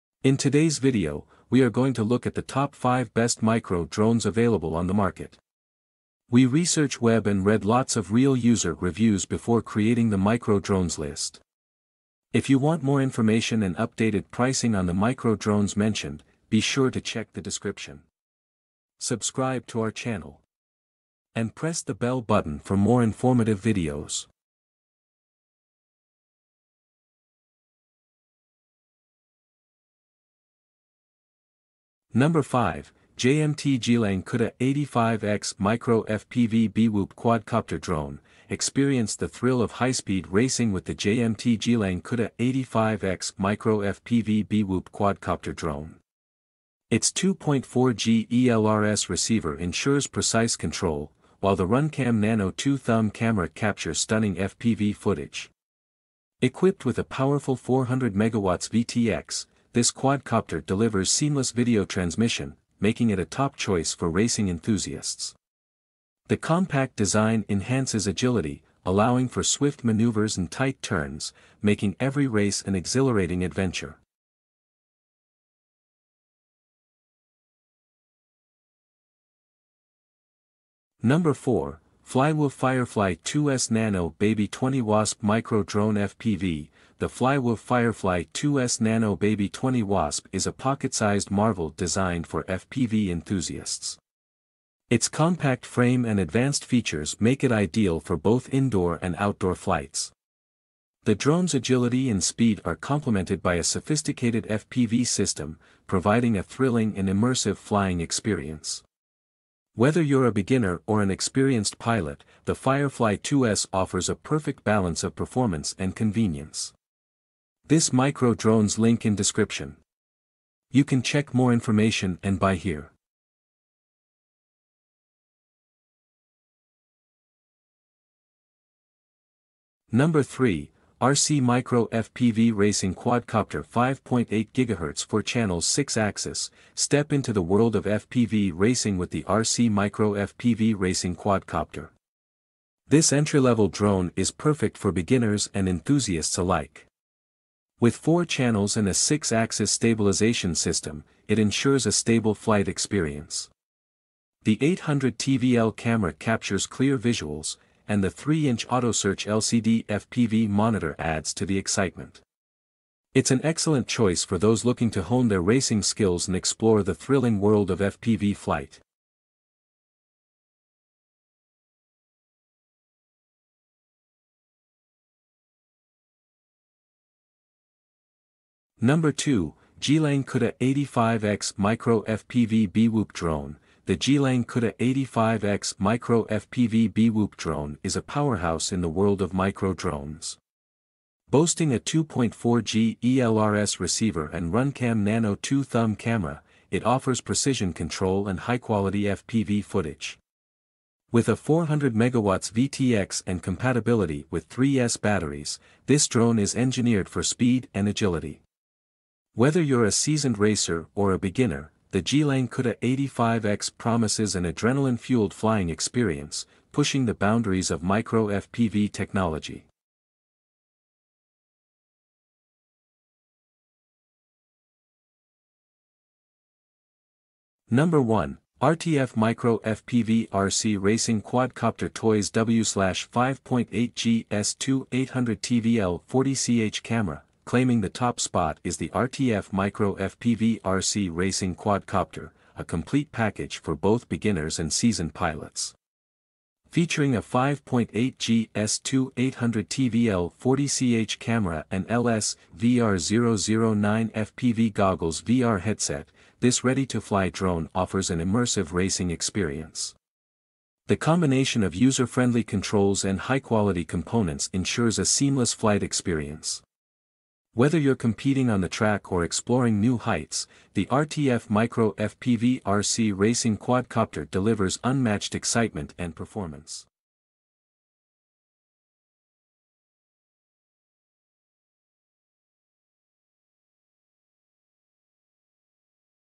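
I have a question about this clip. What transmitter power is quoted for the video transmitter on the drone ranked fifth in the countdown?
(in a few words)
400 MW.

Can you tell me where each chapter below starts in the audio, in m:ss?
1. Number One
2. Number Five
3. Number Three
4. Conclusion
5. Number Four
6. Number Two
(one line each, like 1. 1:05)
1. 3:41
2. 0:26
3. 2:04
4. 4:38
5. 1:15
6. 2:53.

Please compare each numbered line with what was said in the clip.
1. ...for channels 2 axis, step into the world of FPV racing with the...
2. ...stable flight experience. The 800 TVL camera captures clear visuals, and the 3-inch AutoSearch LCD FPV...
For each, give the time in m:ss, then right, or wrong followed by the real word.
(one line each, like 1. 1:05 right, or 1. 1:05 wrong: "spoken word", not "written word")
1. 2:15 wrong: "6", not "2"
2. 2:31 right.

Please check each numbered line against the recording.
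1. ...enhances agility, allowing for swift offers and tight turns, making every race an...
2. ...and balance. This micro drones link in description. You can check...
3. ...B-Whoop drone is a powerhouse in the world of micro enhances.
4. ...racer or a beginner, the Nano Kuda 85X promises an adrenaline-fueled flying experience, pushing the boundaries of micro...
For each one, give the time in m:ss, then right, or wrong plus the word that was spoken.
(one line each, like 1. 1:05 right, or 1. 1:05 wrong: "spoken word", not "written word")
1. 1:07 wrong: "maneuvers", not "offers"
2. 1:55 wrong: "convenience", not "balance"
3. 3:06 wrong: "drones", not "enhances"
4. 3:30 wrong: "Geelang", not "Nano".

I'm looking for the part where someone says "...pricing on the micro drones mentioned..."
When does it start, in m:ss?
0:14.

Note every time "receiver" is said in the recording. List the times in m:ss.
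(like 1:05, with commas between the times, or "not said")
0:49, 3:13.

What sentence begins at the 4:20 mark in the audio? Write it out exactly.
The combination of user-friendly controls and high-quality components ensures a seamless flight experience.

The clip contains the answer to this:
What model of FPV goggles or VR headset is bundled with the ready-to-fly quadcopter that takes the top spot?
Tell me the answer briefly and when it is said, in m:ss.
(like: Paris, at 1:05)
LS VR009, at 4:11.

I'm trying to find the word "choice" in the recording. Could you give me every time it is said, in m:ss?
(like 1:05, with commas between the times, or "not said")
1:03, 2:43.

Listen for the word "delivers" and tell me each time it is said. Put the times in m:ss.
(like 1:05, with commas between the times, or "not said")
1:00, 4:34.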